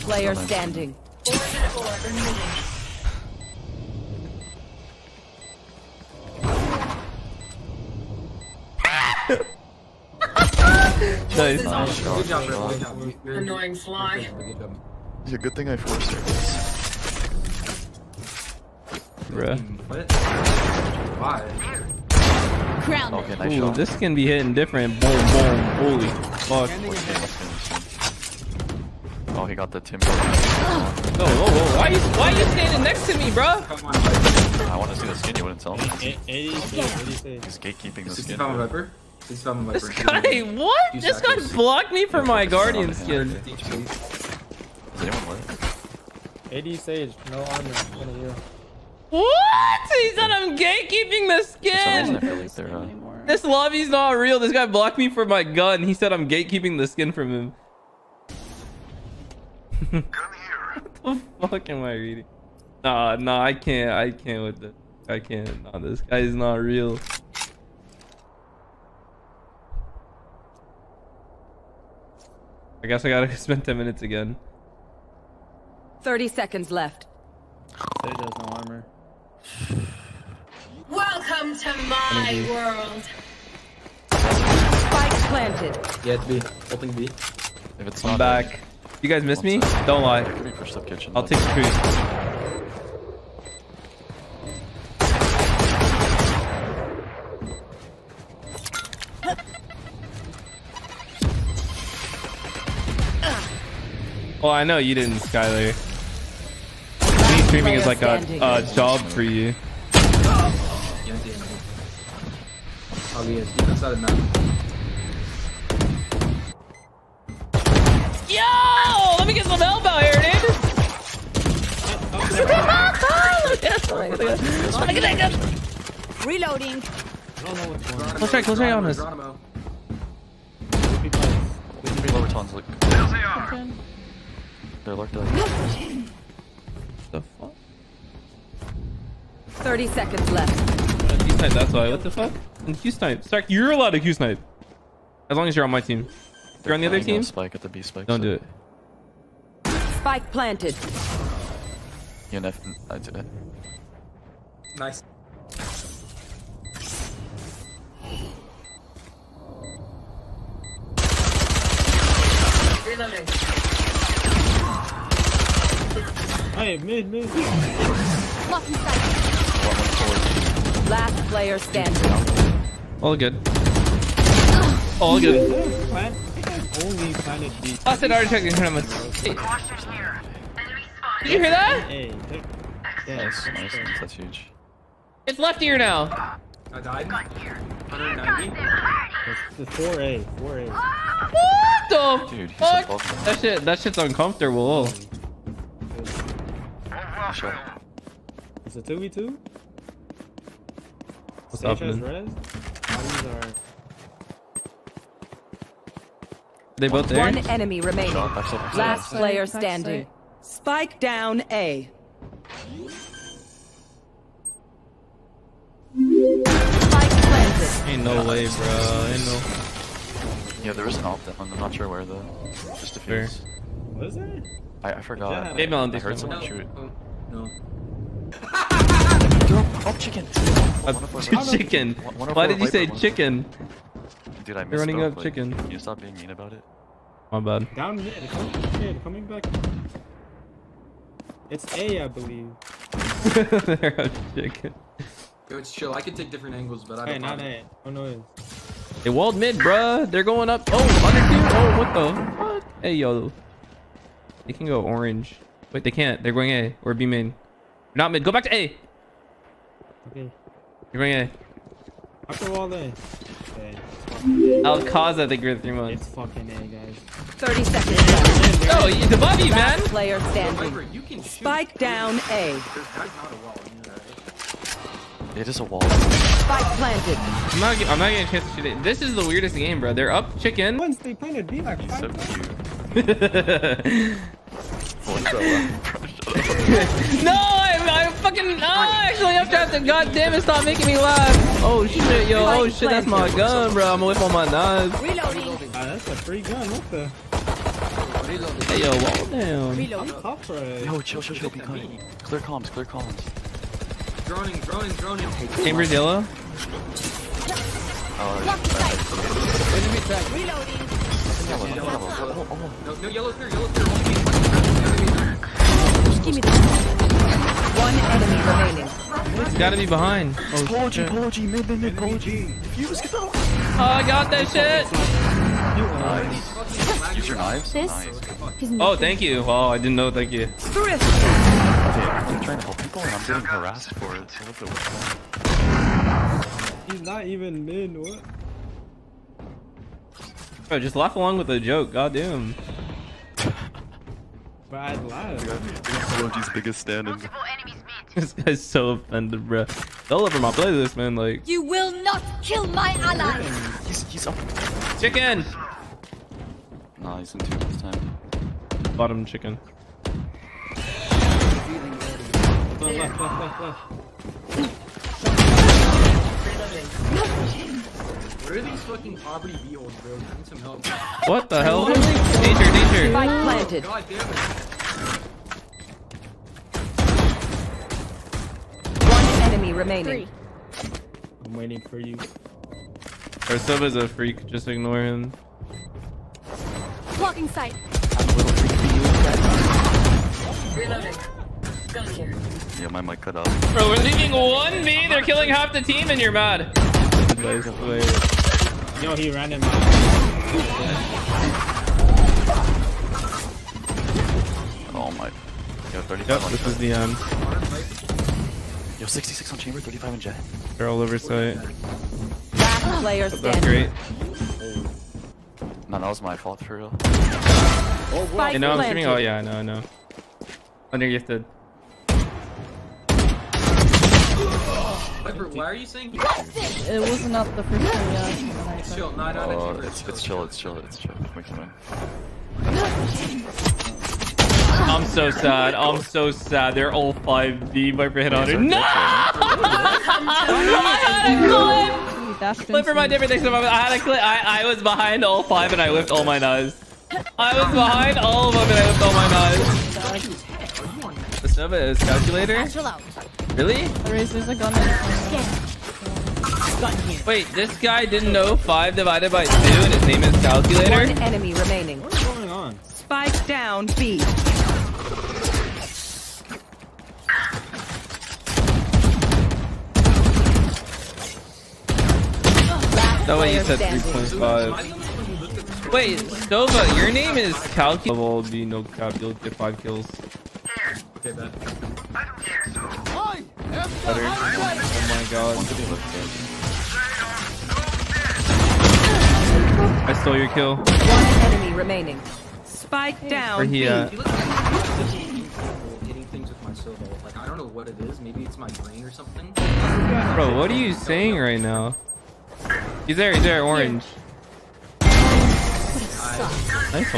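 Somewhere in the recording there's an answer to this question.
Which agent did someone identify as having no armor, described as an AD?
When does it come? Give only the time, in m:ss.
0:46.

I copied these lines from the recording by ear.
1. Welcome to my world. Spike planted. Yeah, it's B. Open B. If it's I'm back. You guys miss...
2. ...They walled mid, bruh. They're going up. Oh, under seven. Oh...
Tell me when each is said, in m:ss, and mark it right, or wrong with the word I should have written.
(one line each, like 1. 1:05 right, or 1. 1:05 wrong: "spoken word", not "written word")
1. 1:20 right
2. 4:09 wrong: "two", not "seven".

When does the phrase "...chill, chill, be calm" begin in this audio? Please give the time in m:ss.
5:01.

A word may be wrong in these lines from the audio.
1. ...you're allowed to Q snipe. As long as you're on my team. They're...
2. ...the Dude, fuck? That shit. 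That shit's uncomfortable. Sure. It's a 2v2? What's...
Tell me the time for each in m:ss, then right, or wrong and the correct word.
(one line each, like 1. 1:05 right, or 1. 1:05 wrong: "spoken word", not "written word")
1. 2:23 right
2. 3:12 right.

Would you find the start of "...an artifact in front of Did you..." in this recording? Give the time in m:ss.
2:58.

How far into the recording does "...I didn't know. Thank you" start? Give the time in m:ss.
5:29.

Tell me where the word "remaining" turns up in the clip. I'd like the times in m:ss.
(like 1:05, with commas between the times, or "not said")
3:27, 5:18, 6:19, 7:41, 8:11.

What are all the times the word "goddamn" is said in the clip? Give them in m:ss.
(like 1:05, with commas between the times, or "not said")
4:49, 5:41.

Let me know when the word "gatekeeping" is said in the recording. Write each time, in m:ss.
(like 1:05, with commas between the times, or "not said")
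0:37, 0:50, 0:56.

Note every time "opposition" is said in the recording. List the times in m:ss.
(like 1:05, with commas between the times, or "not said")
not said.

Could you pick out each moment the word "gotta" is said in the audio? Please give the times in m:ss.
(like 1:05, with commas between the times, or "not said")
1:13, 5:19.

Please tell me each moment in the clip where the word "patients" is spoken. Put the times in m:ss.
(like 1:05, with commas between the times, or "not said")
not said.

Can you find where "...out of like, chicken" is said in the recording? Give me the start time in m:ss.
3:54.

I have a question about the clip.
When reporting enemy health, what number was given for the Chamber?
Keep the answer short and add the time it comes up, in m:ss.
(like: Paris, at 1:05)
66, at 6:49.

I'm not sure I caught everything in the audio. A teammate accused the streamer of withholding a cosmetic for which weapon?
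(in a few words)
Guardian.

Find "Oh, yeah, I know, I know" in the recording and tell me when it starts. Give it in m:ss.
6:59.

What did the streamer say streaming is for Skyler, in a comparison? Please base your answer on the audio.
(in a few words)
a job.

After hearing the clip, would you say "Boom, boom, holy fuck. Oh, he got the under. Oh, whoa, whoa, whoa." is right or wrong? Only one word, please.
wrong.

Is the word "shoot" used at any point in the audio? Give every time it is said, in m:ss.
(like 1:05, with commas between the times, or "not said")
3:46, 4:31, 4:38.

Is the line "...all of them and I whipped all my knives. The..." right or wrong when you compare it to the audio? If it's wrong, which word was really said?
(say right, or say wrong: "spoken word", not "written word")
right.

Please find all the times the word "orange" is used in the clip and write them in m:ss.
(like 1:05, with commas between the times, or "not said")
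4:14, 8:23.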